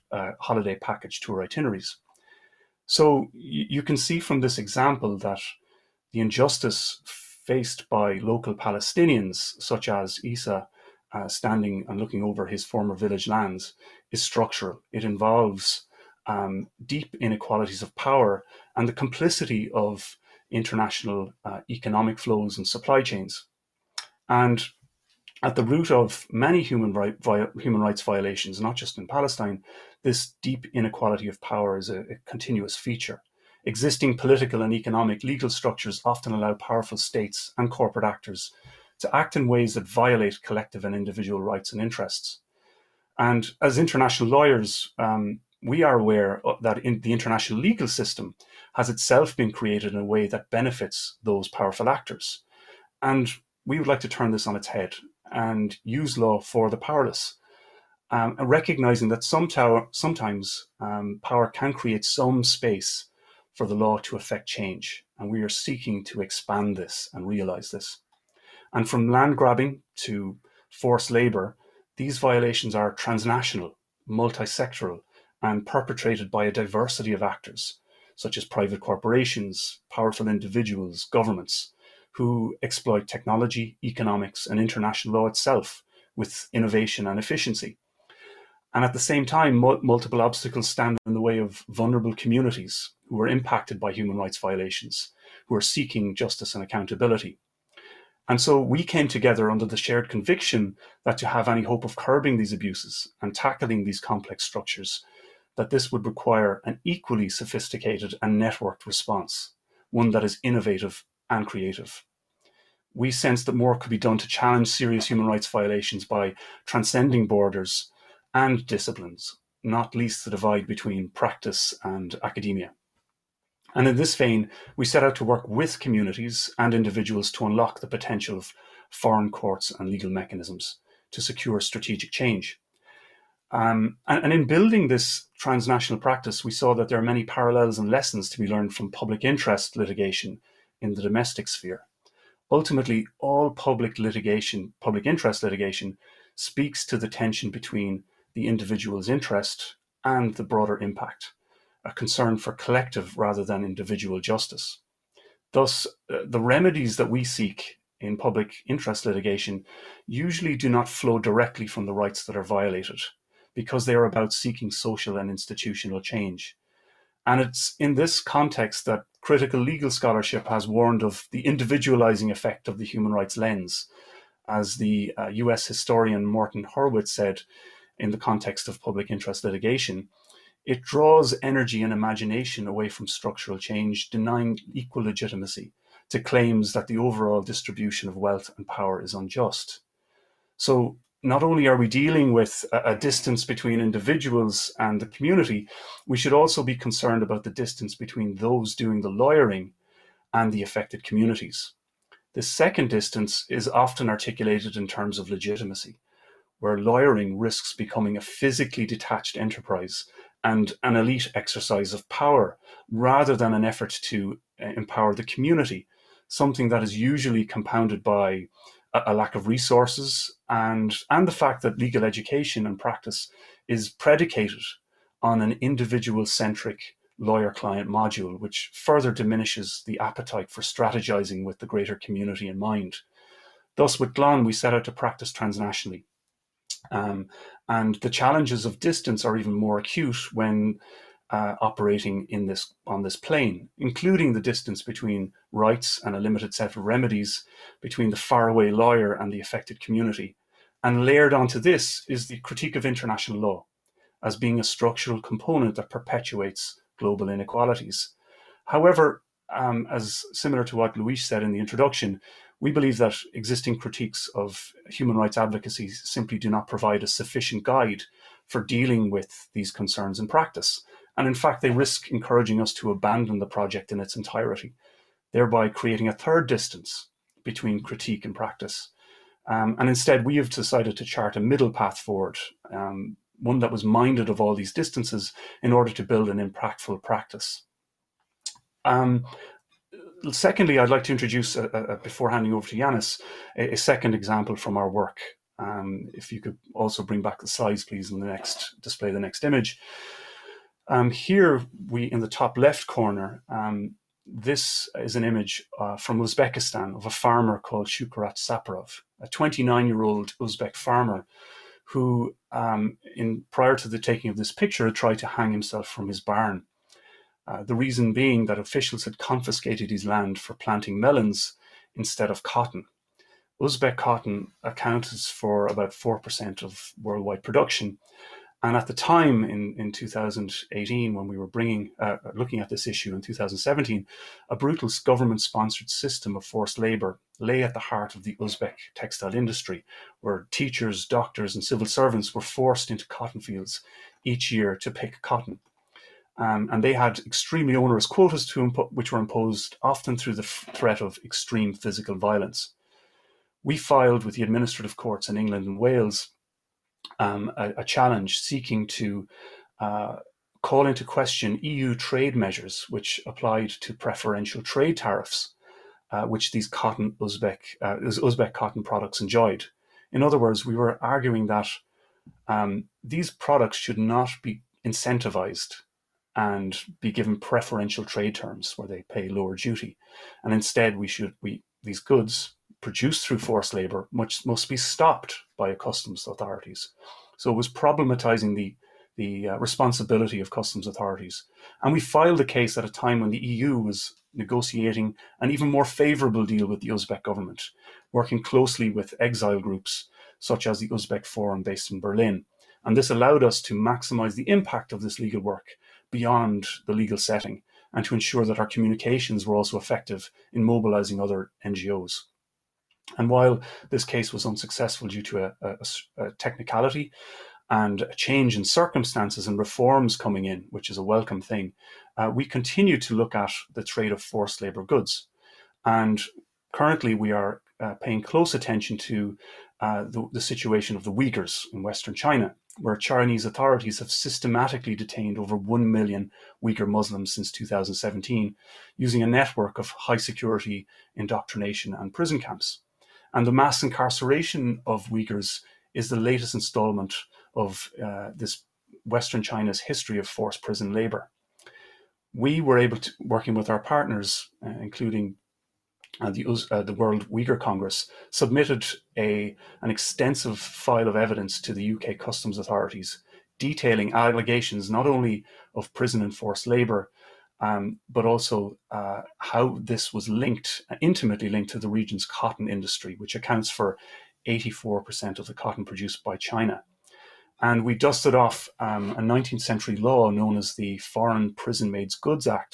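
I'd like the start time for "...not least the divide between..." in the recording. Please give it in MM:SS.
01:59.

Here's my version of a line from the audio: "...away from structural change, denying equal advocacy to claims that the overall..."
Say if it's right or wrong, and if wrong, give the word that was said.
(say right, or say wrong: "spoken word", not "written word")
wrong: "legitimacy", not "advocacy".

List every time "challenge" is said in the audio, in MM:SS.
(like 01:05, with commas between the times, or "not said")
01:54, 03:58, 05:57.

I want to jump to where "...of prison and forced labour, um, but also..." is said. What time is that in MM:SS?
07:45.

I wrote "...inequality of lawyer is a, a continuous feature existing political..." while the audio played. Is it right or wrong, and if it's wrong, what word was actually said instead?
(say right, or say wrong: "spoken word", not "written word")
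wrong: "power", not "lawyer".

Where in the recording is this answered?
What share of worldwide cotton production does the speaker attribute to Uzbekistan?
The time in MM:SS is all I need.
05:25.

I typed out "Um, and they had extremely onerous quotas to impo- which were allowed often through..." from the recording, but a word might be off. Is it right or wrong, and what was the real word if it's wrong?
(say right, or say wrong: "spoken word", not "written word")
wrong: "imposed", not "allowed".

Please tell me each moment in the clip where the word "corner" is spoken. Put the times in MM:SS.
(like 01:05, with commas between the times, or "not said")
05:02.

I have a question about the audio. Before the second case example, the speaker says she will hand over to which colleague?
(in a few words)
Yanis.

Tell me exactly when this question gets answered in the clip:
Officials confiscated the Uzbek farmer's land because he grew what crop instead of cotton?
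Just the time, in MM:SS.
05:20.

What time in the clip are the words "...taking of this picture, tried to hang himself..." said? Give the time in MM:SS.
05:13.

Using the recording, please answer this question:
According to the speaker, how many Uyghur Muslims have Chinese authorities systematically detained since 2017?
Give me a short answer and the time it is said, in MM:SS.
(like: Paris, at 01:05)
Over 1 million, at 07:15.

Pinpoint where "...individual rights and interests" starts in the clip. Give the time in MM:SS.
00:40.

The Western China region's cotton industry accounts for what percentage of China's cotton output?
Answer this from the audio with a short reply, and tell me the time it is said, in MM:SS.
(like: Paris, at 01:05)
84%, at 07:54.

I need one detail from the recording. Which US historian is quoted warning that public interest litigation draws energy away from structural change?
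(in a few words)
Morton Horwitz.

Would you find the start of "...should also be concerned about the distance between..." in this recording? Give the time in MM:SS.
03:16.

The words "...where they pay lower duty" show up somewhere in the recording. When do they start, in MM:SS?
06:18.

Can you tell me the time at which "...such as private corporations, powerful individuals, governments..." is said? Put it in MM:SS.
01:18.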